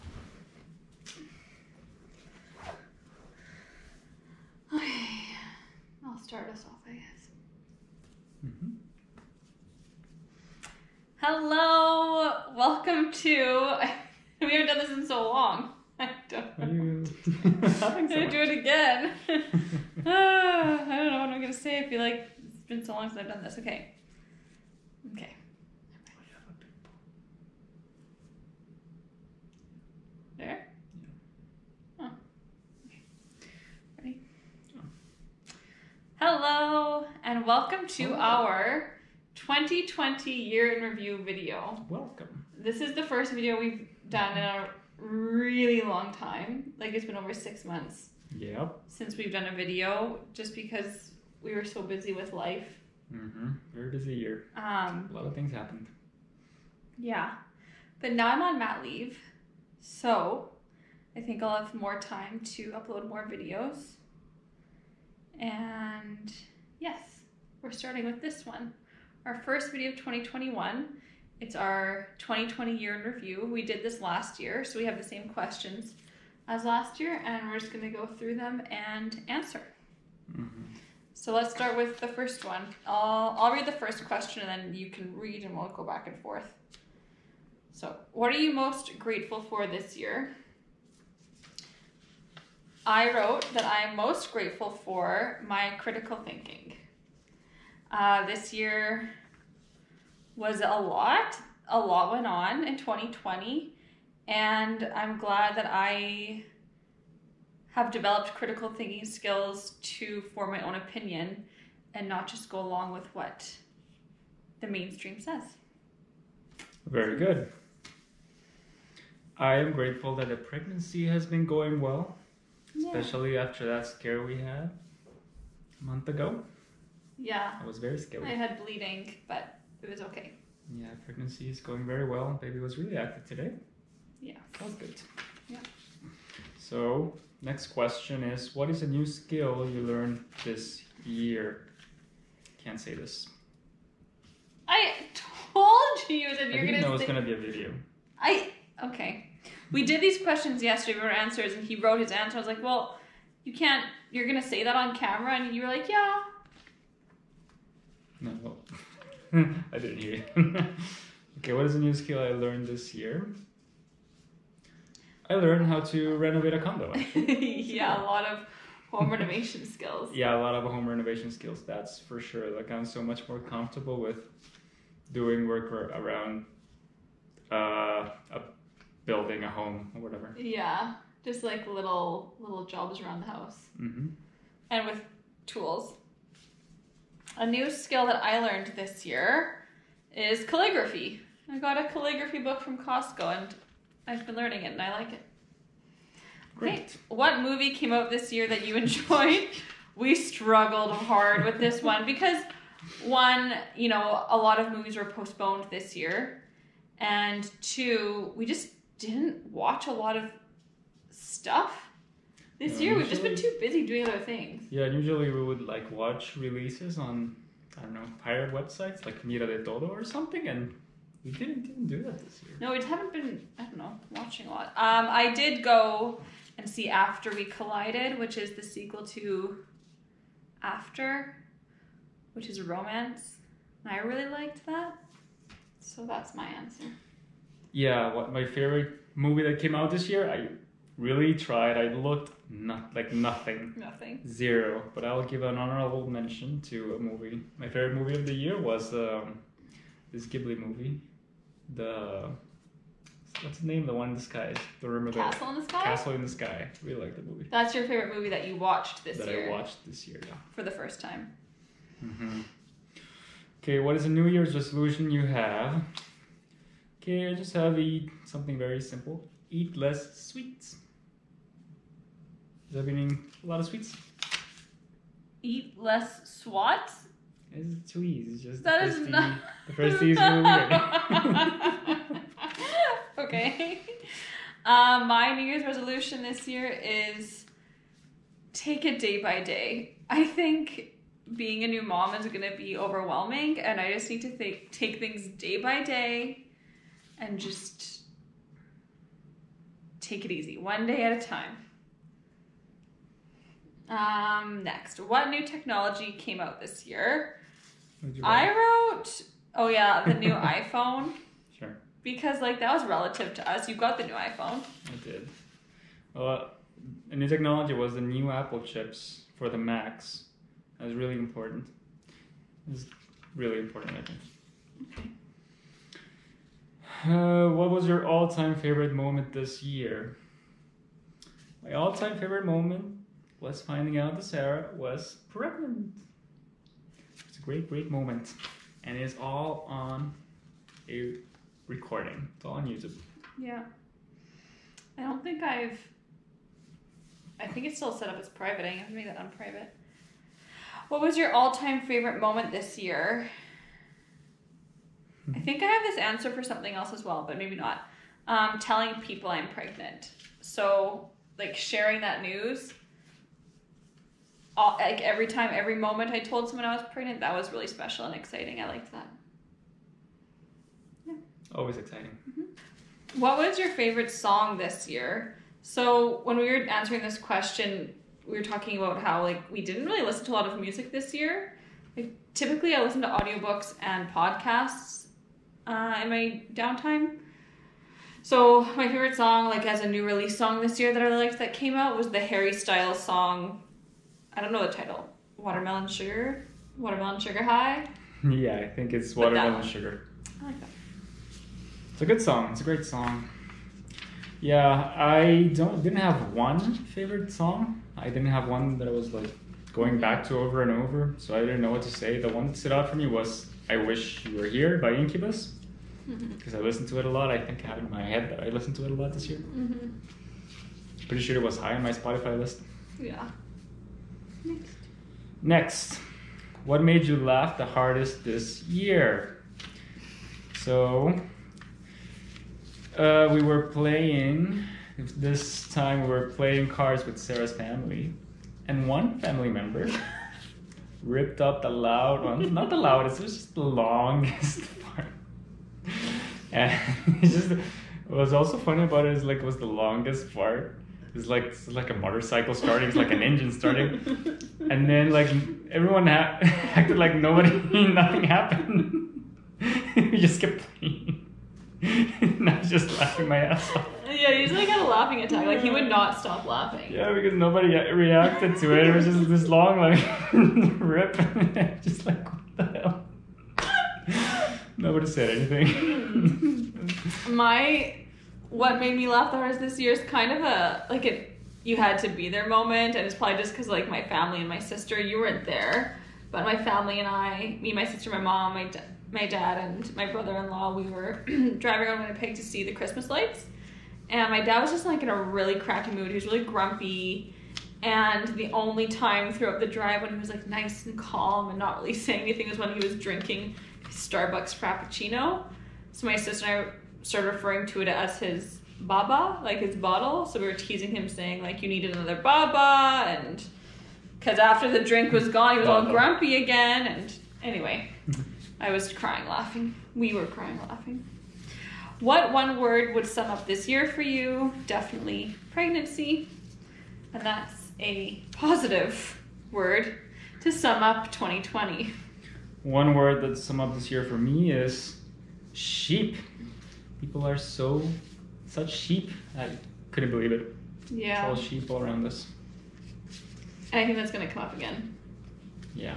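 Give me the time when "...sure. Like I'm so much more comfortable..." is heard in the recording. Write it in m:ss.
2:52.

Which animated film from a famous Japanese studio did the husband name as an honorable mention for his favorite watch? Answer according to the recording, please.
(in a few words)
Castle in the Sky.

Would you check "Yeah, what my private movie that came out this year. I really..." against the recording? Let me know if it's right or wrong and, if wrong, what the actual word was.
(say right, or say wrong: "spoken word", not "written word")
wrong: "favorite", not "private".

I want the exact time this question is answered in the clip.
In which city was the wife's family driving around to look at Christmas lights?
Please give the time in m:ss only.
8:12.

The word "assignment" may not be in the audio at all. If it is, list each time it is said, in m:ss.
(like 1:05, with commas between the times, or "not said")
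not said.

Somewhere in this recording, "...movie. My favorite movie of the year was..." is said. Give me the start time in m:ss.
4:06.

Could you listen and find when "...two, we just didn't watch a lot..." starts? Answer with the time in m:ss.
3:27.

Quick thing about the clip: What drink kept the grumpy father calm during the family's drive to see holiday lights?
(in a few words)
Starbucks Frappuccino.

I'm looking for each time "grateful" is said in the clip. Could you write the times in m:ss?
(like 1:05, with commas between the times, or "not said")
1:28, 1:34, 1:59.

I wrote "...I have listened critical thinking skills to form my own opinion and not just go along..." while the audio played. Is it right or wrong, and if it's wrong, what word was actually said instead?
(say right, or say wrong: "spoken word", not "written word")
wrong: "developed", not "listened".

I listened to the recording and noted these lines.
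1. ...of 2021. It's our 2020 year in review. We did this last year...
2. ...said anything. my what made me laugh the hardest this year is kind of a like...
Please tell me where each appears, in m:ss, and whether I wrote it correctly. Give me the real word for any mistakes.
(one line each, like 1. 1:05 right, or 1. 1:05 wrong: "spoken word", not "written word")
1. 1:09 right
2. 7:55 right.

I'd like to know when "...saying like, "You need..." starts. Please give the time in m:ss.
8:31.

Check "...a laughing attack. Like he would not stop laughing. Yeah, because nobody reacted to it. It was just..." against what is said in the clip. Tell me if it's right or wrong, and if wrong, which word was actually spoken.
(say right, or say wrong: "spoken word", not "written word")
right.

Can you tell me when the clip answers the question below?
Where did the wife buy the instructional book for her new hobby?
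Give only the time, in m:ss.
3:12.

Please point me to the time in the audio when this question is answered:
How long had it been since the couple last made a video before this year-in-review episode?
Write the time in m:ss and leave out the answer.
0:47.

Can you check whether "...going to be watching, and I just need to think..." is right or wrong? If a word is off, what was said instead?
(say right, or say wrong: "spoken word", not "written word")
wrong: "overwhelming", not "watching".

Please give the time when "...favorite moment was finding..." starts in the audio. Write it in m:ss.
5:32.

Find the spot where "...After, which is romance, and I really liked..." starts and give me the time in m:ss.
3:50.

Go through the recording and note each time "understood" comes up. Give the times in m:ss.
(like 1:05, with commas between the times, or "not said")
not said.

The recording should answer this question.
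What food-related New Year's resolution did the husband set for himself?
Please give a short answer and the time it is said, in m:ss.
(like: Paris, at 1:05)
Eat less sweets, at 4:29.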